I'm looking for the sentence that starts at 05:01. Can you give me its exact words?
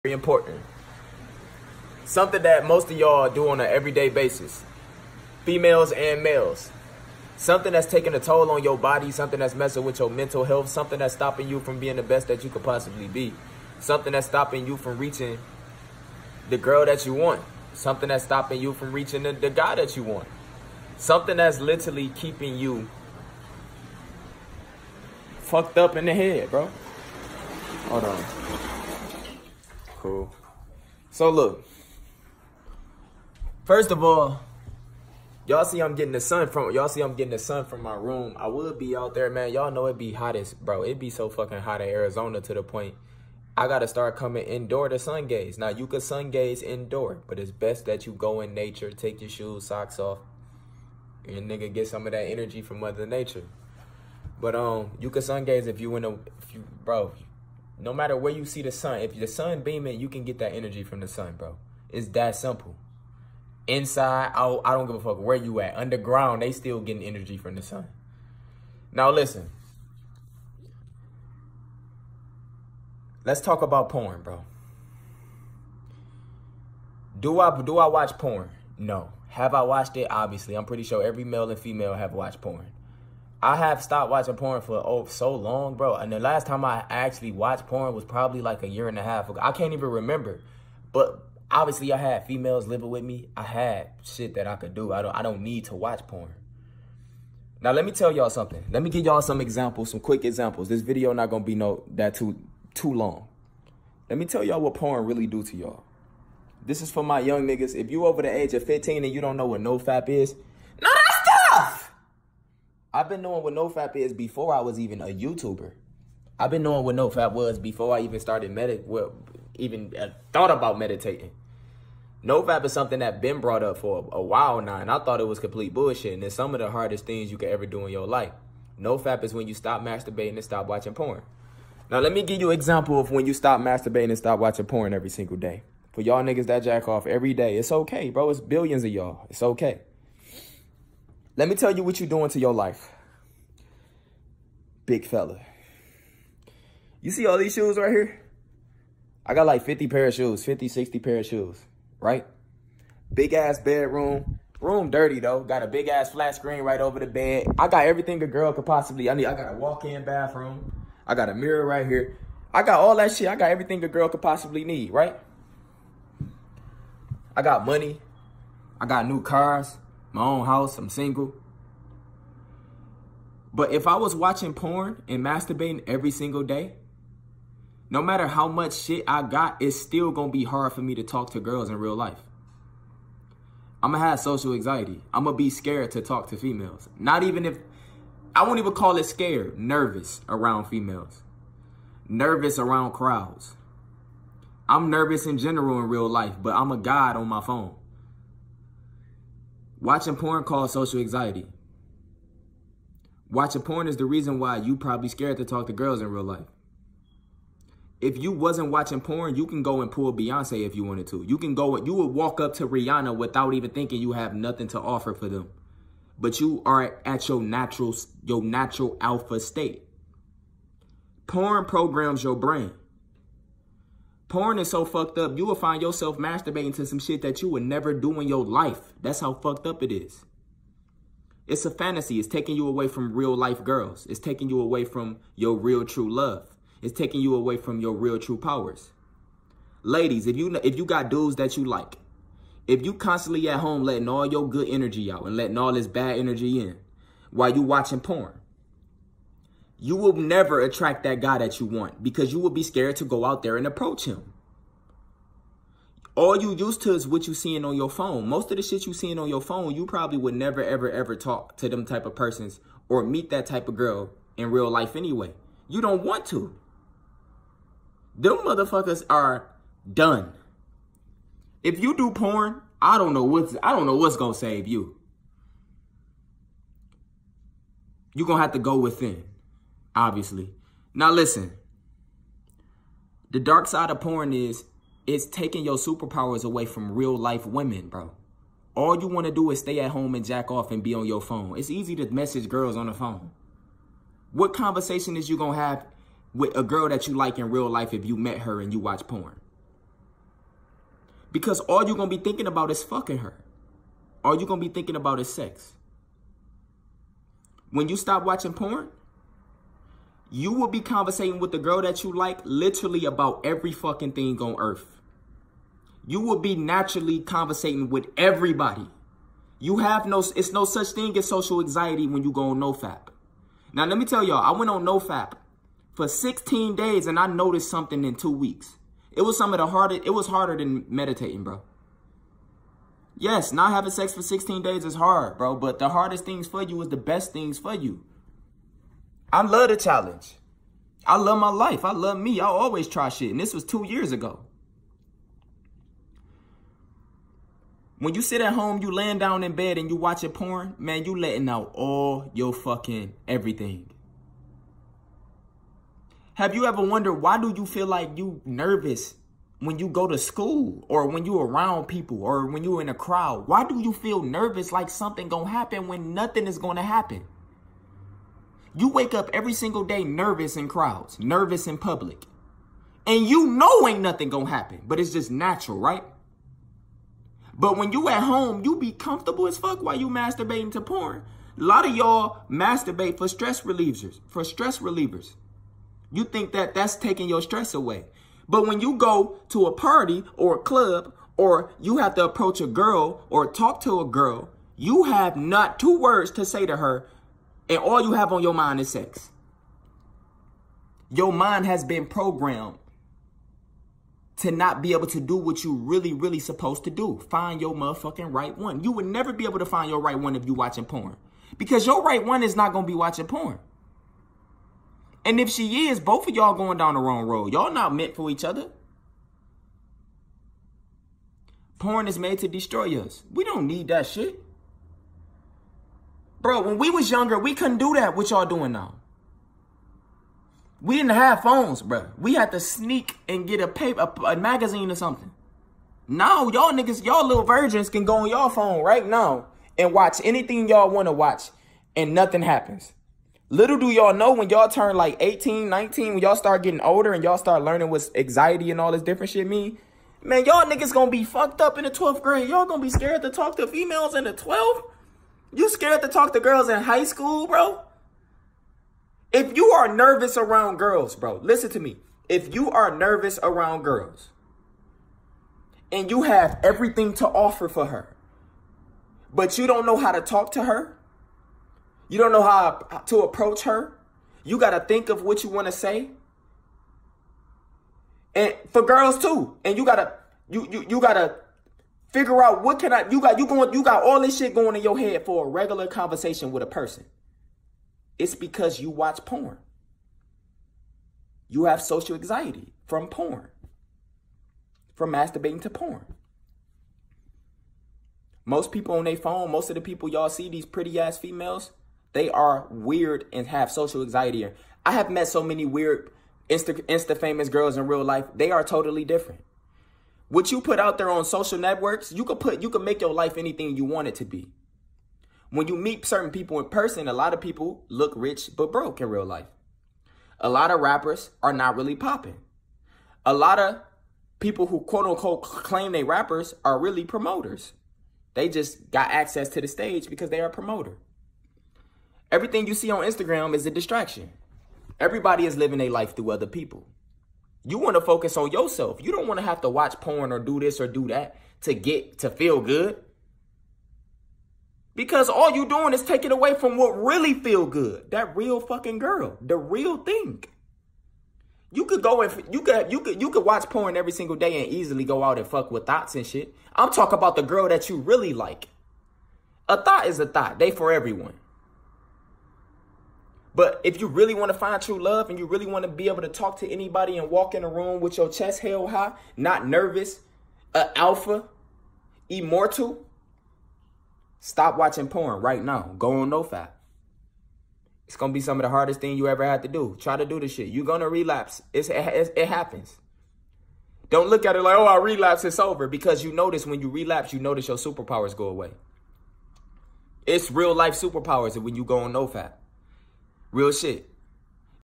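Because all you're going to be thinking about is fucking her.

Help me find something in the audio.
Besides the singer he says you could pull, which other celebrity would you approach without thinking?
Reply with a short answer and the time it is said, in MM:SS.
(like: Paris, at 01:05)
Rihanna, at 03:32.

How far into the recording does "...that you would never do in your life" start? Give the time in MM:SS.
03:47.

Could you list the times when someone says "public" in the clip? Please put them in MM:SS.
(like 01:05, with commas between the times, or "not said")
06:11.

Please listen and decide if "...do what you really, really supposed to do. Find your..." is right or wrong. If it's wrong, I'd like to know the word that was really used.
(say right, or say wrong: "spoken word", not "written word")
right.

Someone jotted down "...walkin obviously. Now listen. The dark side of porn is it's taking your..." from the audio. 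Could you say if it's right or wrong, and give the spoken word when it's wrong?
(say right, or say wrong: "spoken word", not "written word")
wrong: "within", not "walkin".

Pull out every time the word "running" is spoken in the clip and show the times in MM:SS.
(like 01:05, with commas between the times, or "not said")
not said.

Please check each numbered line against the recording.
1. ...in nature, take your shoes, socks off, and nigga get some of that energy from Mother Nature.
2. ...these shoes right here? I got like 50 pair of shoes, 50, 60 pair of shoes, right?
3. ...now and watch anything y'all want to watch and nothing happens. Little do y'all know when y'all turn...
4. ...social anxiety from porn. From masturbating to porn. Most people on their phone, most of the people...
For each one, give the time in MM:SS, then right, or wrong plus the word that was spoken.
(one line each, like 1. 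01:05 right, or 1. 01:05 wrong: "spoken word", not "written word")
1. 00:48 right
2. 02:27 right
3. 07:19 right
4. 08:11 right.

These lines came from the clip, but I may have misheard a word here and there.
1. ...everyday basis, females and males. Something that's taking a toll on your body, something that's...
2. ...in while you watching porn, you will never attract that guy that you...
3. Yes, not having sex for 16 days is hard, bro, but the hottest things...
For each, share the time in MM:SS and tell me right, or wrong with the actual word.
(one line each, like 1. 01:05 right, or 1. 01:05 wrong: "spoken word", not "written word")
1. 00:03 right
2. 04:06 right
3. 05:33 wrong: "hardest", not "hottest".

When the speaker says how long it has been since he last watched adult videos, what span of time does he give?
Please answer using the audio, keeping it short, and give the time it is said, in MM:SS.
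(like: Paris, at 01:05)
a year and a half, at 01:28.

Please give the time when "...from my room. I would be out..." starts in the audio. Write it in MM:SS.
00:37.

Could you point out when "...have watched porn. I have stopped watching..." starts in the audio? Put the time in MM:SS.
01:21.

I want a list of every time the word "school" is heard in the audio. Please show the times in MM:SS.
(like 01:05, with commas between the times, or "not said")
06:00, 07:37.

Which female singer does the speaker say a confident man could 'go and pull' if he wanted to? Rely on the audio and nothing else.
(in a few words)
Beyonce.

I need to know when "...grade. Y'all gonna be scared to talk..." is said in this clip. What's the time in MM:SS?
07:32.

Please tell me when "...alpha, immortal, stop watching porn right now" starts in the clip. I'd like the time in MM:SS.
09:30.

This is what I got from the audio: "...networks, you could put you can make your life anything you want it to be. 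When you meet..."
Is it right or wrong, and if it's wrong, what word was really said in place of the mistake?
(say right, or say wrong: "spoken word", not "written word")
right.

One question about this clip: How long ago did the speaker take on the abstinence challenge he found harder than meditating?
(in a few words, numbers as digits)
two years ago.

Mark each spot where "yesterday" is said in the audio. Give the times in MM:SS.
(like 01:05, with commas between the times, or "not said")
not said.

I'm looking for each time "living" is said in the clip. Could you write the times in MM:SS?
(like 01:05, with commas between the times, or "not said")
01:32, 08:55.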